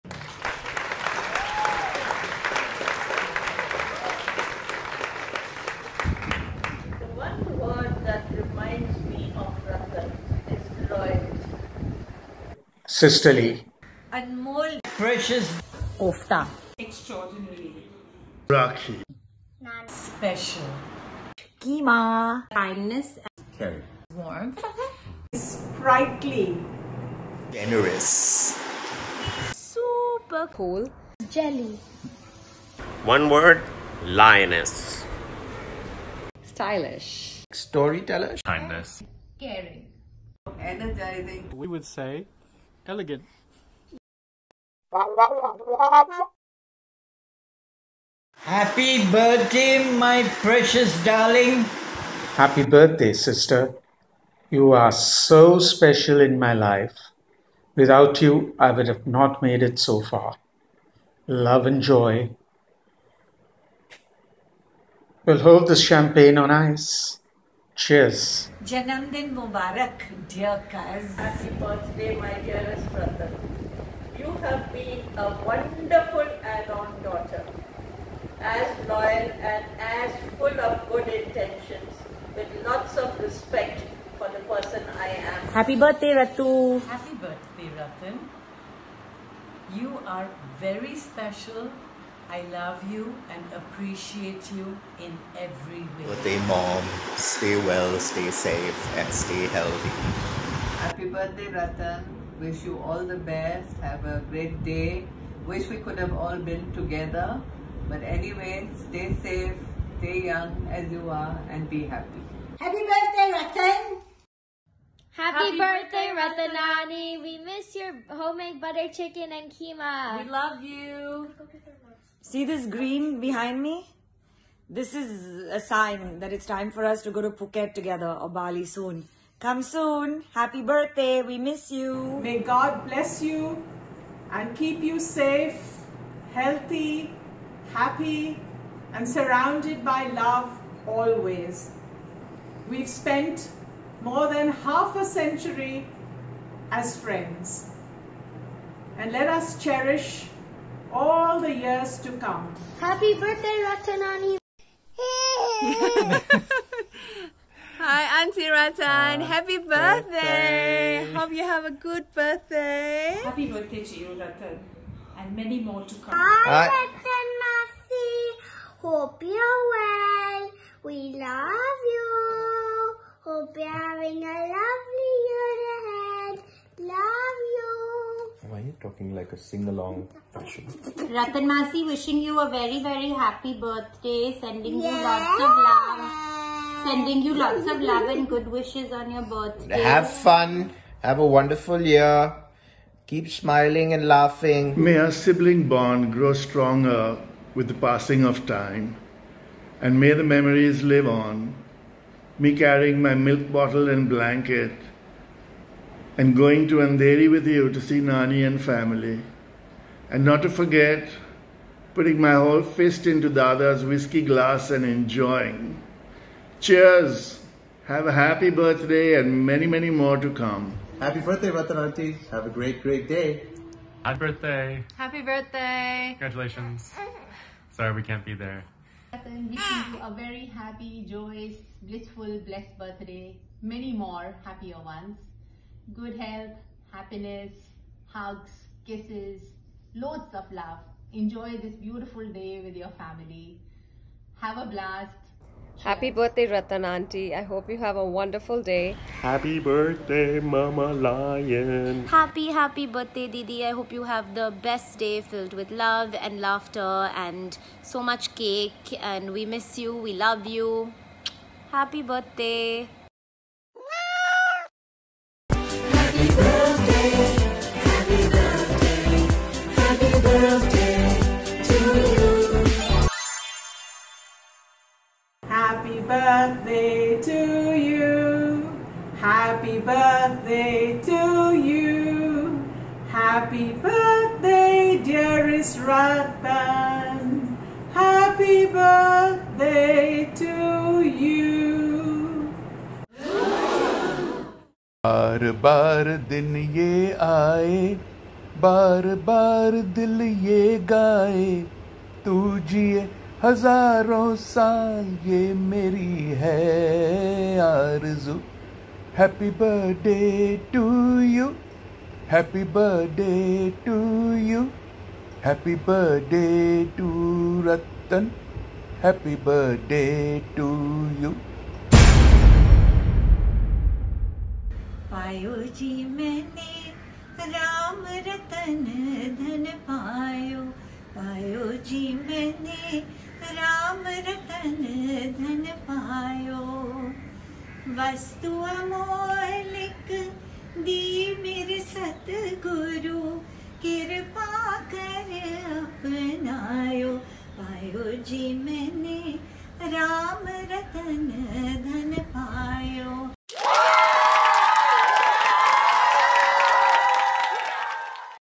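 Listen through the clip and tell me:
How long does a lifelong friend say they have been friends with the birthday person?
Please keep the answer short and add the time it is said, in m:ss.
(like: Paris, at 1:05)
more than half a century, at 2:24.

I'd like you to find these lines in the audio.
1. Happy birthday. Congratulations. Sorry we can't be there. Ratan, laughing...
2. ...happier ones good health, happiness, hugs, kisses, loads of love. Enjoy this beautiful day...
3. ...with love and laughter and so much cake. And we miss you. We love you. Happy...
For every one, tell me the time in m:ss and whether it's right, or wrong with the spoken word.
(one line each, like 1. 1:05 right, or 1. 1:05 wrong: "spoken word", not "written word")
1. 3:44 wrong: "wishing", not "laughing"
2. 3:54 right
3. 4:15 right.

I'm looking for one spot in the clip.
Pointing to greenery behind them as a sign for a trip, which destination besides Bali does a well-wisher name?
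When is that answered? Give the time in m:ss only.
2:07.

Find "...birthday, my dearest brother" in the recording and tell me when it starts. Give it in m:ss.
1:11.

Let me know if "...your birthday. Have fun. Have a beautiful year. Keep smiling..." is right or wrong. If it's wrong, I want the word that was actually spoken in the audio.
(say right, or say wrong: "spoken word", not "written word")
wrong: "wonderful", not "beautiful".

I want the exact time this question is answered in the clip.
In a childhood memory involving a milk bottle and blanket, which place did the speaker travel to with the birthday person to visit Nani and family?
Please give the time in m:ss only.
3:26.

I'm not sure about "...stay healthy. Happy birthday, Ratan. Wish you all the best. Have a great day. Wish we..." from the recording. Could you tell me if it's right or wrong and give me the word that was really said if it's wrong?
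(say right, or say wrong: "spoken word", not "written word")
right.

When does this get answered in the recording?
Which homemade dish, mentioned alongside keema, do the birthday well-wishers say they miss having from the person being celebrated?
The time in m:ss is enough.
1:58.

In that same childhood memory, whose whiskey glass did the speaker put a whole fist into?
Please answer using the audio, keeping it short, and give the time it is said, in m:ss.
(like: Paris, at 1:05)
Dada's, at 3:33.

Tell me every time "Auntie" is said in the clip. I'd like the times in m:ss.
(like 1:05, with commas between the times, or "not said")
2:38, 4:06.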